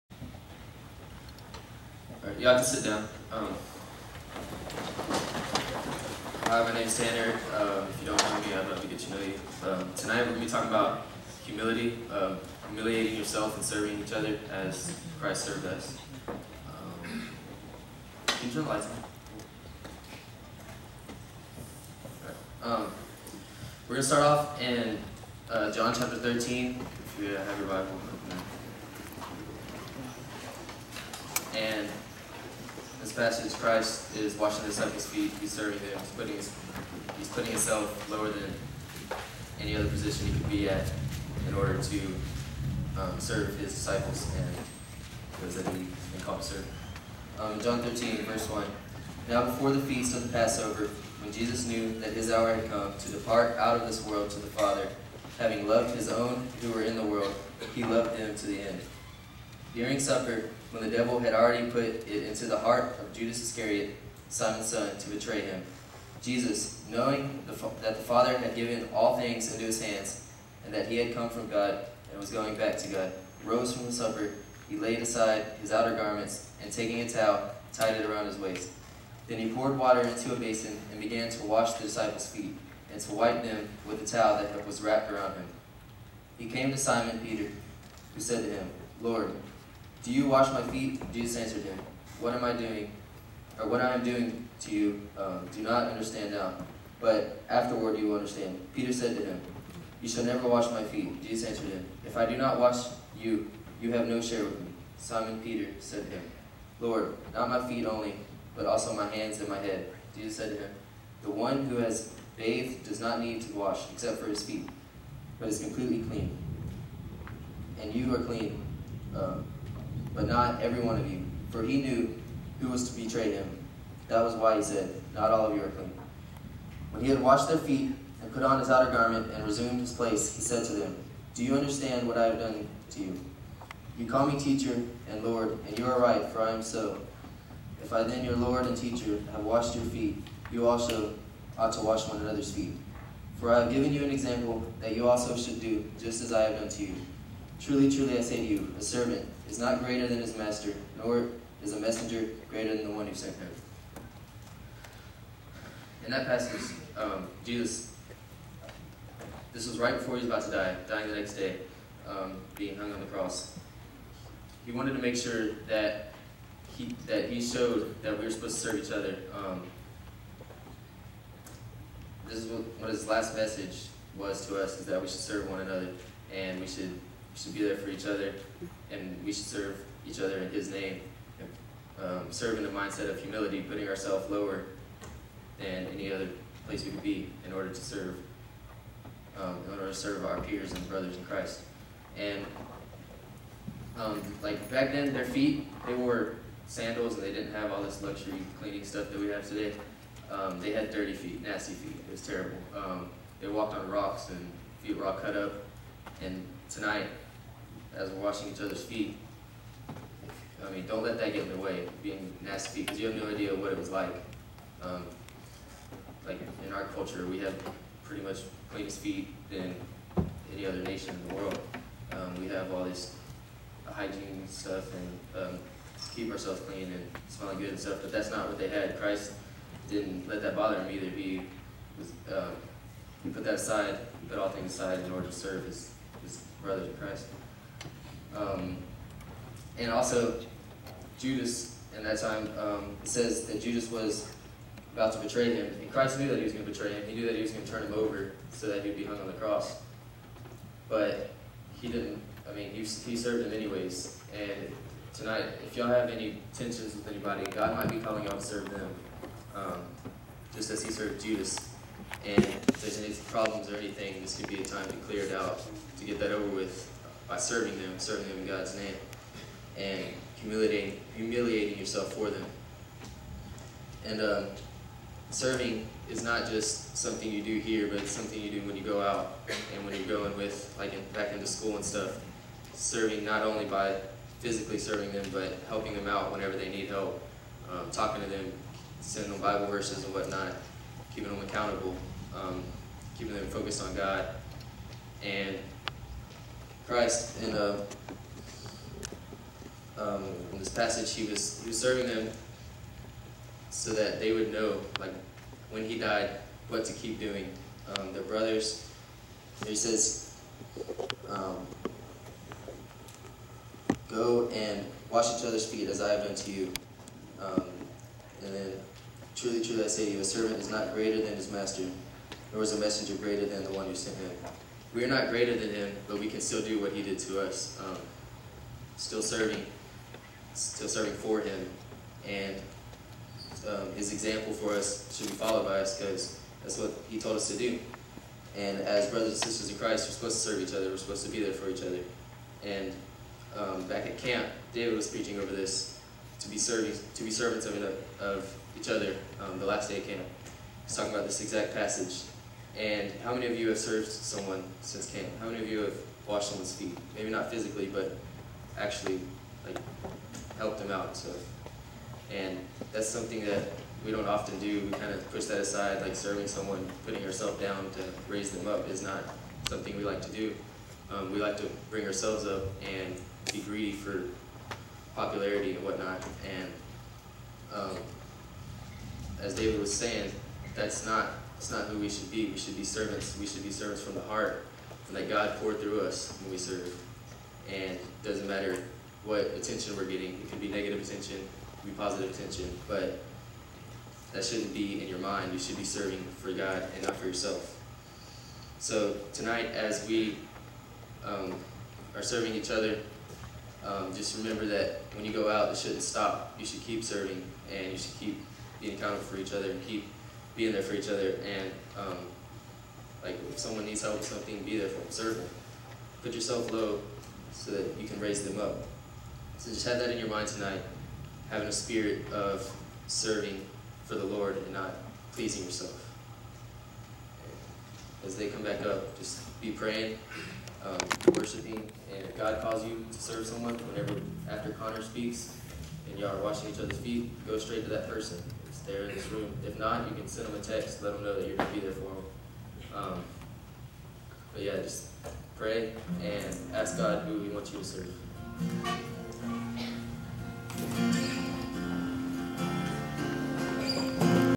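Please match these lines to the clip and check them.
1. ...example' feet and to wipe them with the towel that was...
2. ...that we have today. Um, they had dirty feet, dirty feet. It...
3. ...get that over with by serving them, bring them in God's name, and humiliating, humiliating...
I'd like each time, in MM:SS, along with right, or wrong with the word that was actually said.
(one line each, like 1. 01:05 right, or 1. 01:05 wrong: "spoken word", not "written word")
1. 01:21 wrong: "disciples", not "example"
2. 03:19 wrong: "nasty", not "dirty"
3. 04:26 wrong: "serving", not "bring".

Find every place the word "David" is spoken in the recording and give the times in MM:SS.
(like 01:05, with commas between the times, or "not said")
05:44, 06:19.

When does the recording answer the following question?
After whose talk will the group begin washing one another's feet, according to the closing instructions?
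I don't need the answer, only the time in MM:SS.
07:14.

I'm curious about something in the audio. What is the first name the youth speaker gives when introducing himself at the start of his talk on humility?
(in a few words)
Tanner.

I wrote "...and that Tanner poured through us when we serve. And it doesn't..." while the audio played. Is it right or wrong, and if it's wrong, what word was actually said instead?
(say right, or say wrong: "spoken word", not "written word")
wrong: "God", not "Tanner".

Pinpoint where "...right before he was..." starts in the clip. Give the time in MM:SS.
02:39.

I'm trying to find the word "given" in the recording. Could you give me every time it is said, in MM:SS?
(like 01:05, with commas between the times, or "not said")
01:08, 02:23.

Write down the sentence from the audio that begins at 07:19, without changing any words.
If not, you can send them a text, let them know that you're going to be there for them.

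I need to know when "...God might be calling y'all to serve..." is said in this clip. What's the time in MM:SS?
04:17.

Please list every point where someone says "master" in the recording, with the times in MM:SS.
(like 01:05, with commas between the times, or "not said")
02:30, 05:21.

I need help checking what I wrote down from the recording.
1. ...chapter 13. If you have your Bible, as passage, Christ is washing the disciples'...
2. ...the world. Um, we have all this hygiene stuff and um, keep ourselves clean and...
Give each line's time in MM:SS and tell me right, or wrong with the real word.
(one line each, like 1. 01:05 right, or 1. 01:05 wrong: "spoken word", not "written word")
1. 00:25 right
2. 03:41 right.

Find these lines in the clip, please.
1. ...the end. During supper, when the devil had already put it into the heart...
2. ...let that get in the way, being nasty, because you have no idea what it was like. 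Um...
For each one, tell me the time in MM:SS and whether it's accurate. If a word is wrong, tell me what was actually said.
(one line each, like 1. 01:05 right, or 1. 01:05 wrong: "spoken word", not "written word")
1. 00:58 right
2. 03:31 right.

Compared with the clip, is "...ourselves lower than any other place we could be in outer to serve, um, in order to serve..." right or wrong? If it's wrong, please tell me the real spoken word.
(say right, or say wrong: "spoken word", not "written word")
wrong: "order", not "outer".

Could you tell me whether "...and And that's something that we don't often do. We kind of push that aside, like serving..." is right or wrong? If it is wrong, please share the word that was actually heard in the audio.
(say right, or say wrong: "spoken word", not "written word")
right.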